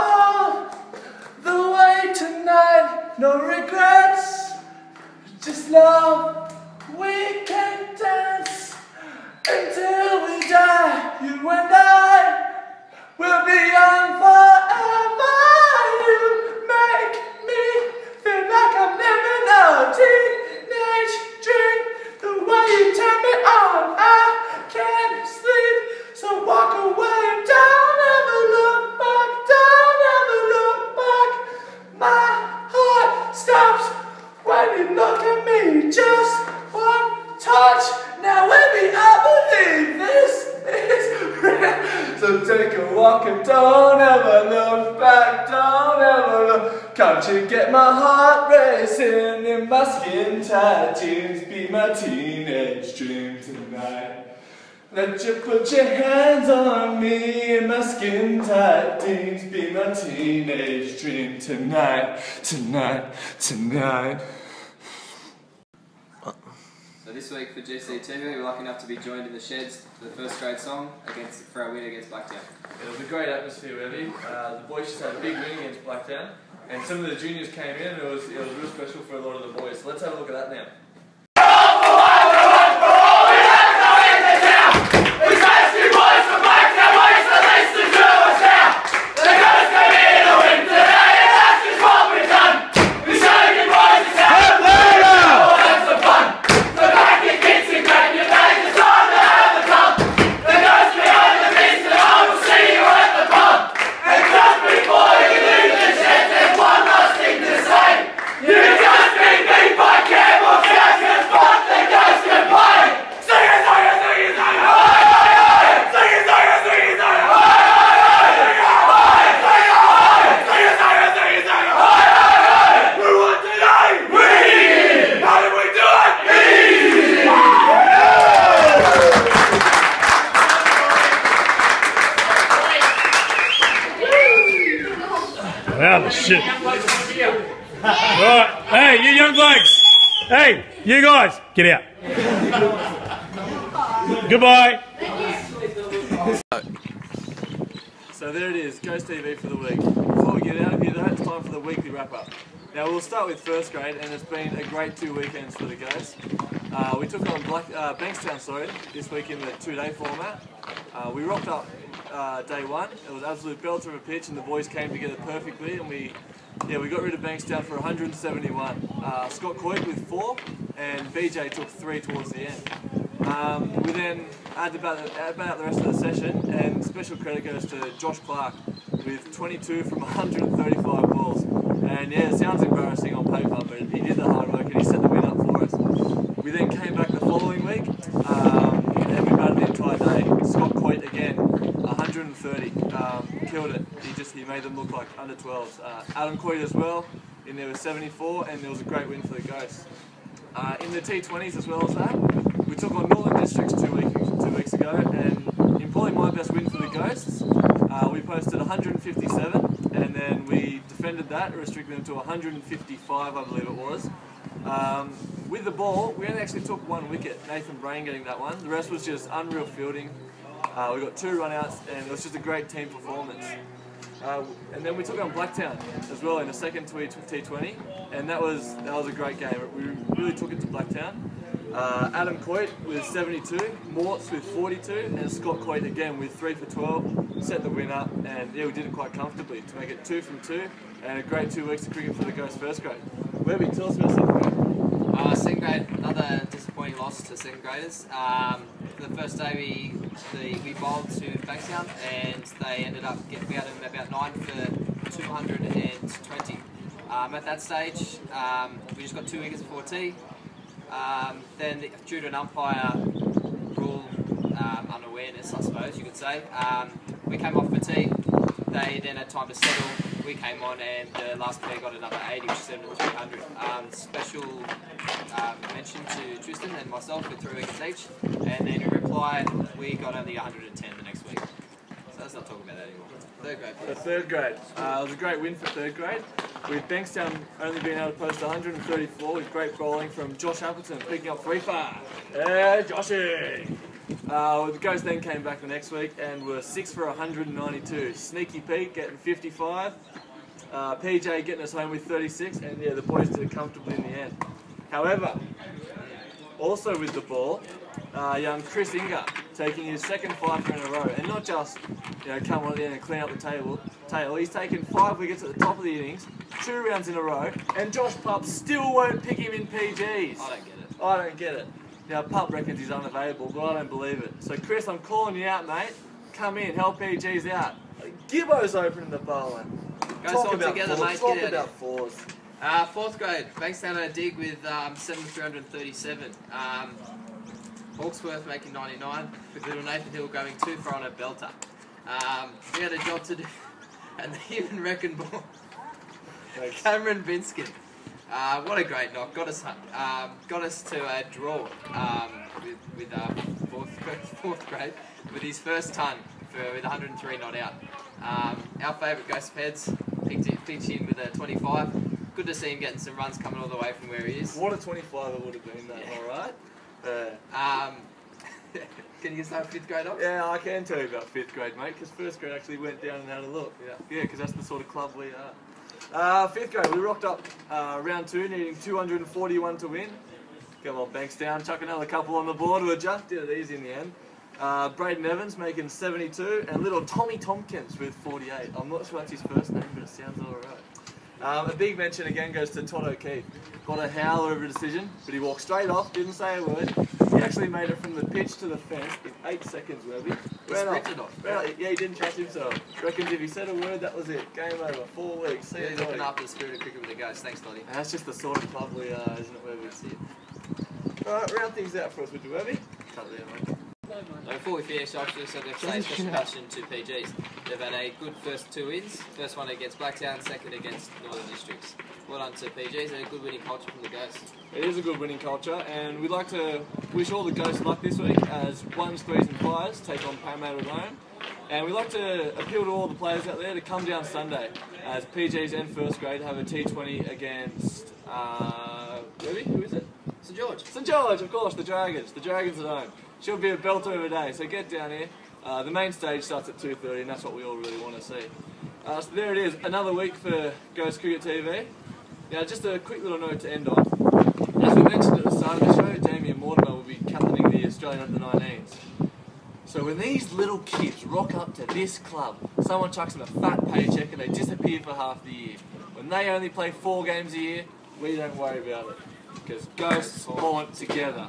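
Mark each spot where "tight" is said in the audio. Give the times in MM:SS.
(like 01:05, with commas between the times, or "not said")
00:50, 00:58.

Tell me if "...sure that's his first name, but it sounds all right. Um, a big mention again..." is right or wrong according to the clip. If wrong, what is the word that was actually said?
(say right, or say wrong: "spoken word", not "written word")
right.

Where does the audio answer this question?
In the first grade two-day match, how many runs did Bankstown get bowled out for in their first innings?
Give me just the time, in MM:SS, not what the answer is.
02:47.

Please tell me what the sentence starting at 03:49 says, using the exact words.
We really took it to Blacktown.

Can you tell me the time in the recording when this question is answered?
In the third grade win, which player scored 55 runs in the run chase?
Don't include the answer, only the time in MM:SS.
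04:58.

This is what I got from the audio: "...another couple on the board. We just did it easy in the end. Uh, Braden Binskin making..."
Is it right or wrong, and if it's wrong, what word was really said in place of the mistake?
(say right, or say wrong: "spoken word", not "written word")
wrong: "Evans", not "Binskin".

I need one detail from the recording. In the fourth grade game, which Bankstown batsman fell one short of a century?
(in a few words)
Hawksworth.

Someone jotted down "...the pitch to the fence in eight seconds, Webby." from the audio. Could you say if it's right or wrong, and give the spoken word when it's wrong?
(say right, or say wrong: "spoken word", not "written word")
right.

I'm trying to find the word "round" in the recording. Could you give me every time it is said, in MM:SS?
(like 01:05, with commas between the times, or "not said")
05:16, 06:18, 06:51.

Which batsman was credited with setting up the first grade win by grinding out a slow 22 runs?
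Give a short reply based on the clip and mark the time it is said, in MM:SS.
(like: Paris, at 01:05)
Josh Clark, at 02:57.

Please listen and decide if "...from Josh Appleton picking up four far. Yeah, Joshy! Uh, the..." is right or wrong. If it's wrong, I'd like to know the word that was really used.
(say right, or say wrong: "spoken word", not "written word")
wrong: "three", not "four".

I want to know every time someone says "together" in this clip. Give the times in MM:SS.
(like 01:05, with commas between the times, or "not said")
02:44, 05:30, 07:50.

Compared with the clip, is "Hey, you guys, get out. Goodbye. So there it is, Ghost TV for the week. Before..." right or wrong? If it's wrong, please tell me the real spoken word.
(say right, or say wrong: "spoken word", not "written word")
right.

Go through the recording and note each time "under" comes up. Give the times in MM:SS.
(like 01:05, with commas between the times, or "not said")
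03:15, 07:38.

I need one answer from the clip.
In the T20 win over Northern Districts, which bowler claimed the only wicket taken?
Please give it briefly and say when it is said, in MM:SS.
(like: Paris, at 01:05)
Nathan Brain, at 03:37.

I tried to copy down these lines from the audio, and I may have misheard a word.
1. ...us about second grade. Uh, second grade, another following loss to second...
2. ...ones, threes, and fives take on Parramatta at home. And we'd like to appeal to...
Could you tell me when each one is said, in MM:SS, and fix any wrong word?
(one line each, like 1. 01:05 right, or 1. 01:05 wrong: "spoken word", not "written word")
1. 04:03 wrong: "disappointing", not "following"
2. 07:08 right.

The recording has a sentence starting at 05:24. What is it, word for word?
So, Chris, I'm calling you out, mate.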